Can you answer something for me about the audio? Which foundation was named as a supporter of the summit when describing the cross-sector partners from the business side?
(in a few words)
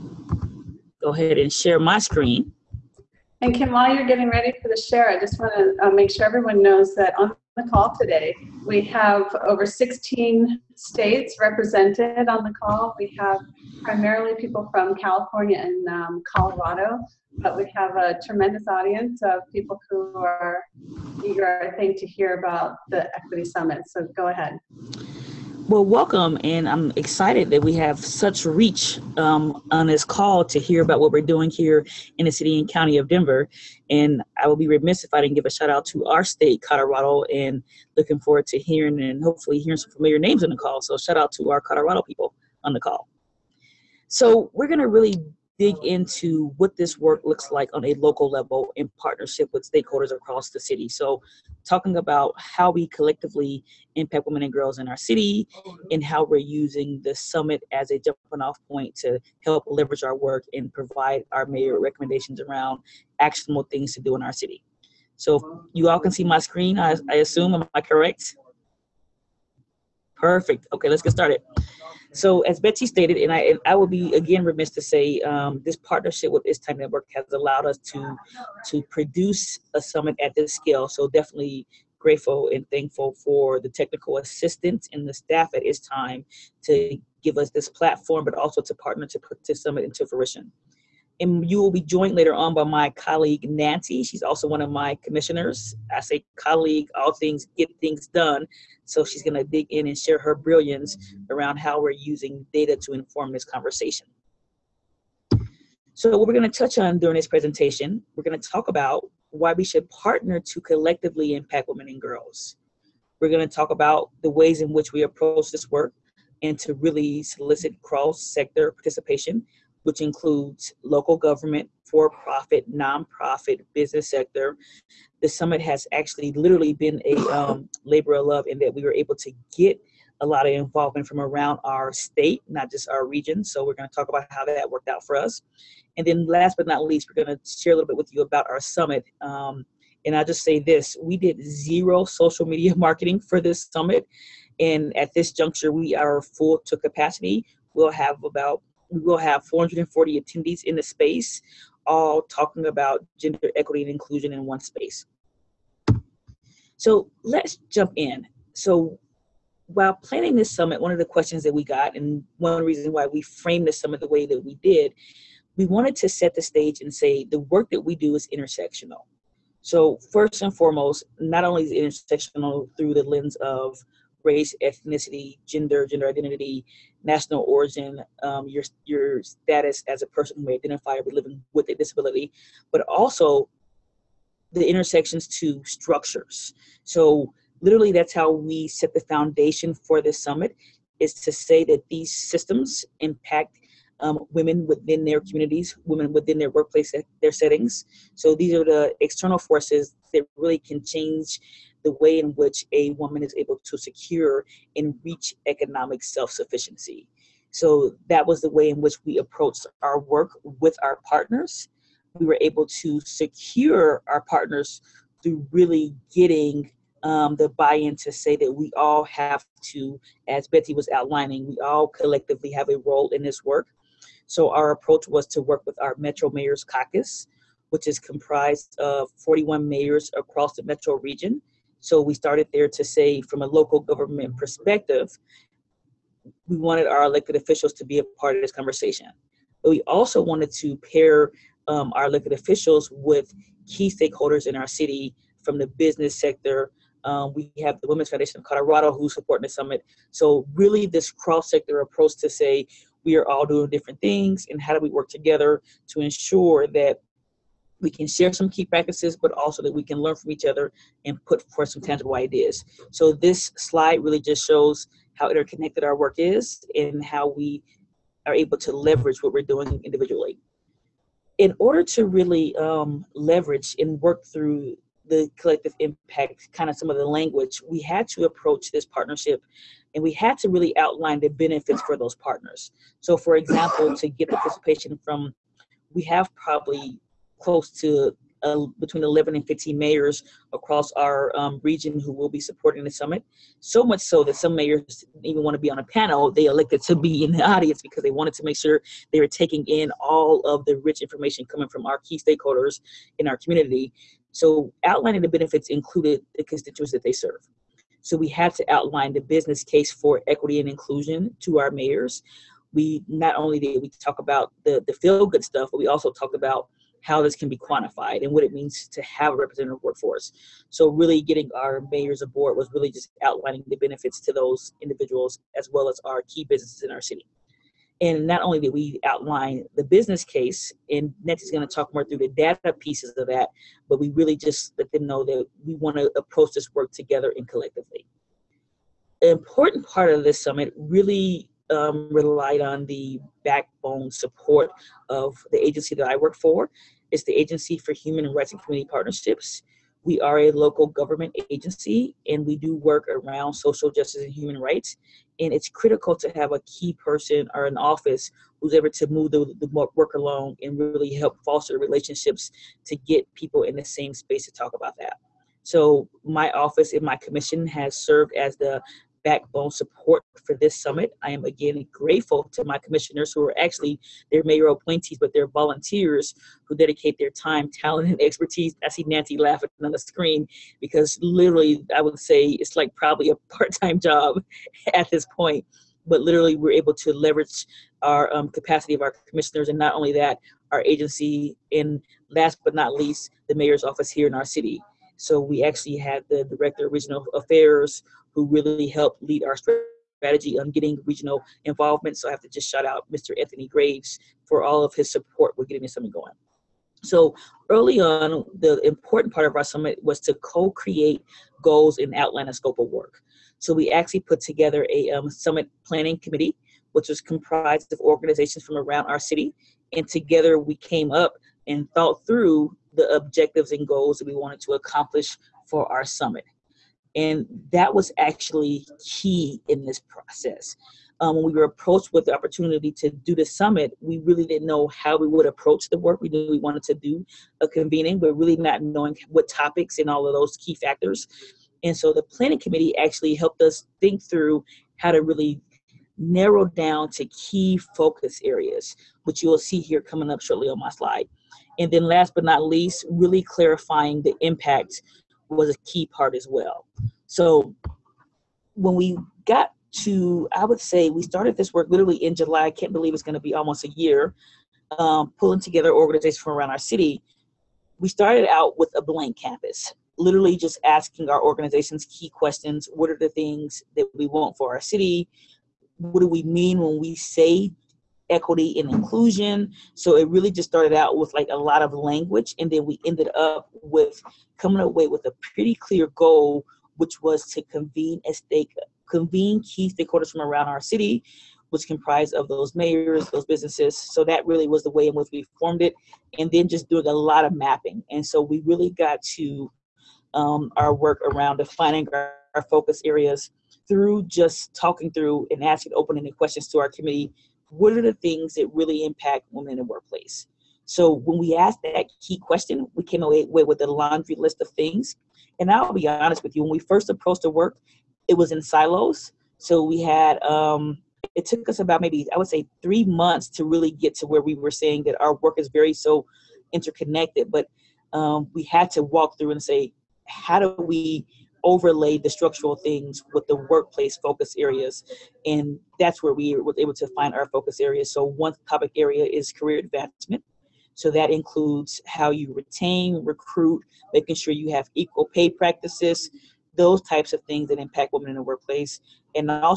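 Women's Foundation of Colorado.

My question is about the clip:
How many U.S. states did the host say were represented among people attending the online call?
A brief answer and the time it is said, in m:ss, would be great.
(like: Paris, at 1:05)
16, at 0:09.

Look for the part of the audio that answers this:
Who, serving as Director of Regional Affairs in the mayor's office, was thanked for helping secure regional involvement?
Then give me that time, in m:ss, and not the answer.
6:43.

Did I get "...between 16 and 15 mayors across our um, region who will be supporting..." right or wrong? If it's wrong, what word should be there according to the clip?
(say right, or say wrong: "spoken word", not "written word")
wrong: "11", not "16".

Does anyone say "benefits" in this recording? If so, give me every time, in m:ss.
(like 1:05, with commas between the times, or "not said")
4:41, 5:05, 5:23.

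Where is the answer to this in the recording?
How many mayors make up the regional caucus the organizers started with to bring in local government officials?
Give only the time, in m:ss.
3:49.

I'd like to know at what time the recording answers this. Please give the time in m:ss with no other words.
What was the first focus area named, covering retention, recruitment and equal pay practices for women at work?
8:59.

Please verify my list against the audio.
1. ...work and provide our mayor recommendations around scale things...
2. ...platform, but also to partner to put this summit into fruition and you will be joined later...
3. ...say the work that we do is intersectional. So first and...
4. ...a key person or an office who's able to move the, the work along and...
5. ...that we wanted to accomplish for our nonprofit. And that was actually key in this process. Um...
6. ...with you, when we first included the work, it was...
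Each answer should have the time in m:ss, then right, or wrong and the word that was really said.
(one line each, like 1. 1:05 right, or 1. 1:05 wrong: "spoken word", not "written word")
1. 1:00 wrong: "actionable", not "scale"
2. 1:27 right
3. 2:46 right
4. 5:56 right
5. 7:04 wrong: "summit", not "nonprofit"
6. 8:36 wrong: "approached", not "included".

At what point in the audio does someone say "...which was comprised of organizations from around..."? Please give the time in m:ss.
6:56.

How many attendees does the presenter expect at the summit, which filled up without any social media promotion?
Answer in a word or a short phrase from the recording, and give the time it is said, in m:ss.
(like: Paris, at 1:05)
440, at 2:29.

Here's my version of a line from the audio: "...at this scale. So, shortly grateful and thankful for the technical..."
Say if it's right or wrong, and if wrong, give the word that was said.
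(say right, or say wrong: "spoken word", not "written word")
wrong: "definitely", not "shortly".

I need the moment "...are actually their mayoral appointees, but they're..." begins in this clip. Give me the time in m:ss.
6:13.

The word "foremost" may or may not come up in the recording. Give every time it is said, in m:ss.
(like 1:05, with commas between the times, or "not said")
2:50.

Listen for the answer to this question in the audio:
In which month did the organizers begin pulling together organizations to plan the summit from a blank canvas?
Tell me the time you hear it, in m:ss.
7:42.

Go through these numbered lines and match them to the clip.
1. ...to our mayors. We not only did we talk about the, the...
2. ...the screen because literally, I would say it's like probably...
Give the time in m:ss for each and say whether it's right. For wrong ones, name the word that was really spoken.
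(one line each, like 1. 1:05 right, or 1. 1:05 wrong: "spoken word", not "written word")
1. 5:11 right
2. 6:19 right.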